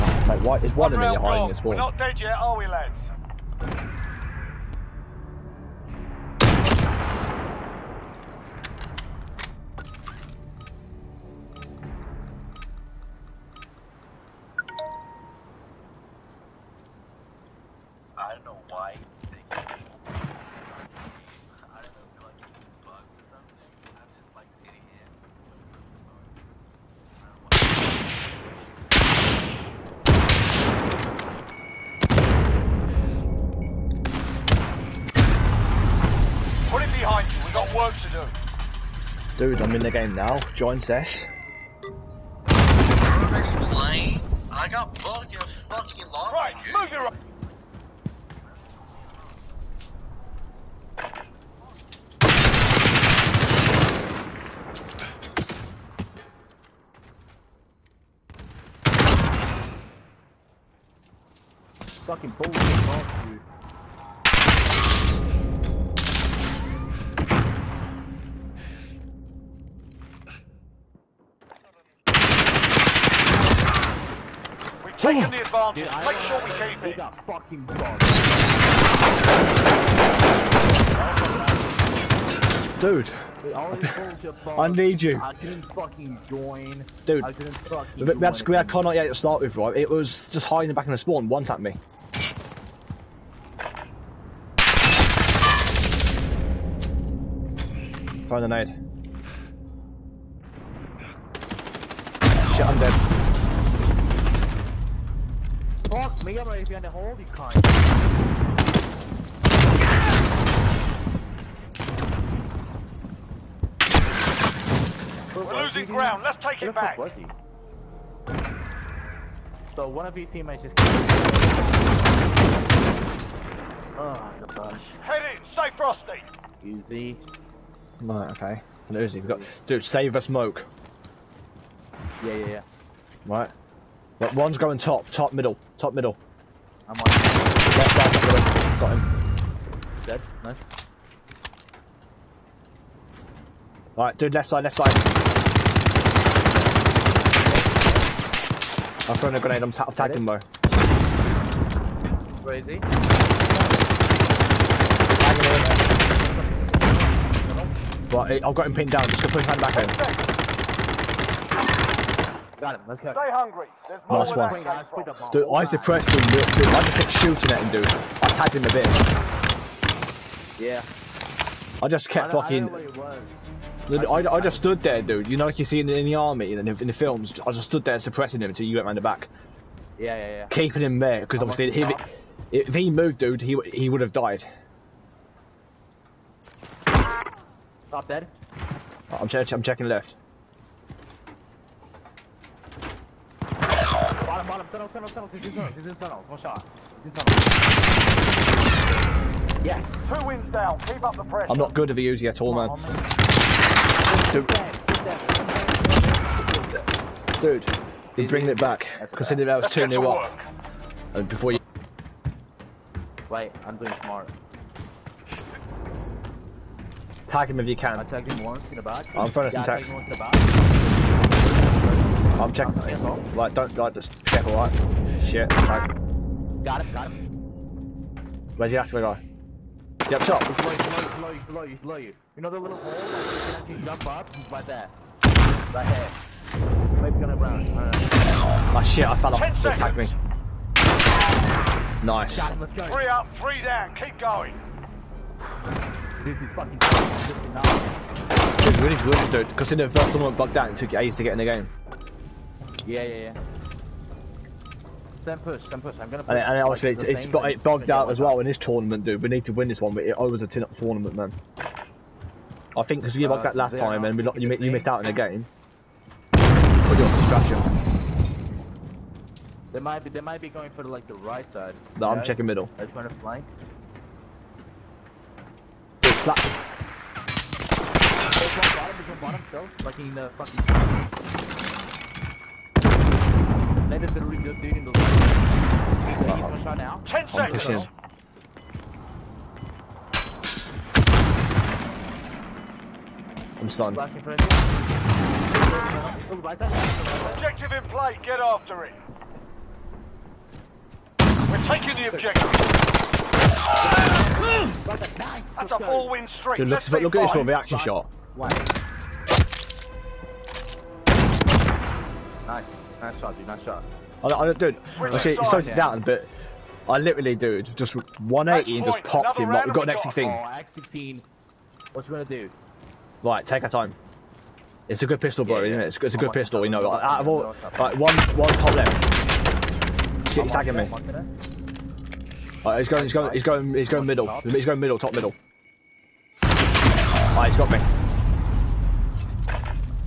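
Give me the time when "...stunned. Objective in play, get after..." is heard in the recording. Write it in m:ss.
4:53.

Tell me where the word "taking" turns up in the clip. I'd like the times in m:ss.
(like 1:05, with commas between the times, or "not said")
5:01.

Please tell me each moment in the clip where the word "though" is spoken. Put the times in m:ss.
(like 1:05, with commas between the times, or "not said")
2:30.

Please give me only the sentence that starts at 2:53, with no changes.
I, I, I, just stood there, dude.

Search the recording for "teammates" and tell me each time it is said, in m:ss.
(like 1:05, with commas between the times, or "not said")
2:00.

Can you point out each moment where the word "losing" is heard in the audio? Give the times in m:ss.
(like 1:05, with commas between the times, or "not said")
1:55, 2:08.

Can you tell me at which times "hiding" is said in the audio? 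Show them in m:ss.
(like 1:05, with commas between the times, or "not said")
1:30.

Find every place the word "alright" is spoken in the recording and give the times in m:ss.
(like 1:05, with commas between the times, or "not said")
2:23, 3:44, 5:36.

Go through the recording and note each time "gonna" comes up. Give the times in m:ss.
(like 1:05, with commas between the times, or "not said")
3:57, 4:16, 5:22.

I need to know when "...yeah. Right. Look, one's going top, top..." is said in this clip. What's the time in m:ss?
2:12.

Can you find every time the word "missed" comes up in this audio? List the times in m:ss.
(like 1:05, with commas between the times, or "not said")
4:24.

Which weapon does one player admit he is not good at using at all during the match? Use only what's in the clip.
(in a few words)
Uzi.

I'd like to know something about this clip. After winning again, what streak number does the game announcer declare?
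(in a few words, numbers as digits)
four-win streak.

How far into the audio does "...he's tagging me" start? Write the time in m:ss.
5:30.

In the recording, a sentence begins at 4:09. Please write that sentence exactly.
Because in the first one bugged out, and took you ages to get in the game.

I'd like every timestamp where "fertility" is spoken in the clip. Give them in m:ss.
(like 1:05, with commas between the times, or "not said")
not said.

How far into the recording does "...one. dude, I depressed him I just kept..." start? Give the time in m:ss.
2:44.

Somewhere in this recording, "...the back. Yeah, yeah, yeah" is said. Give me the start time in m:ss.
2:58.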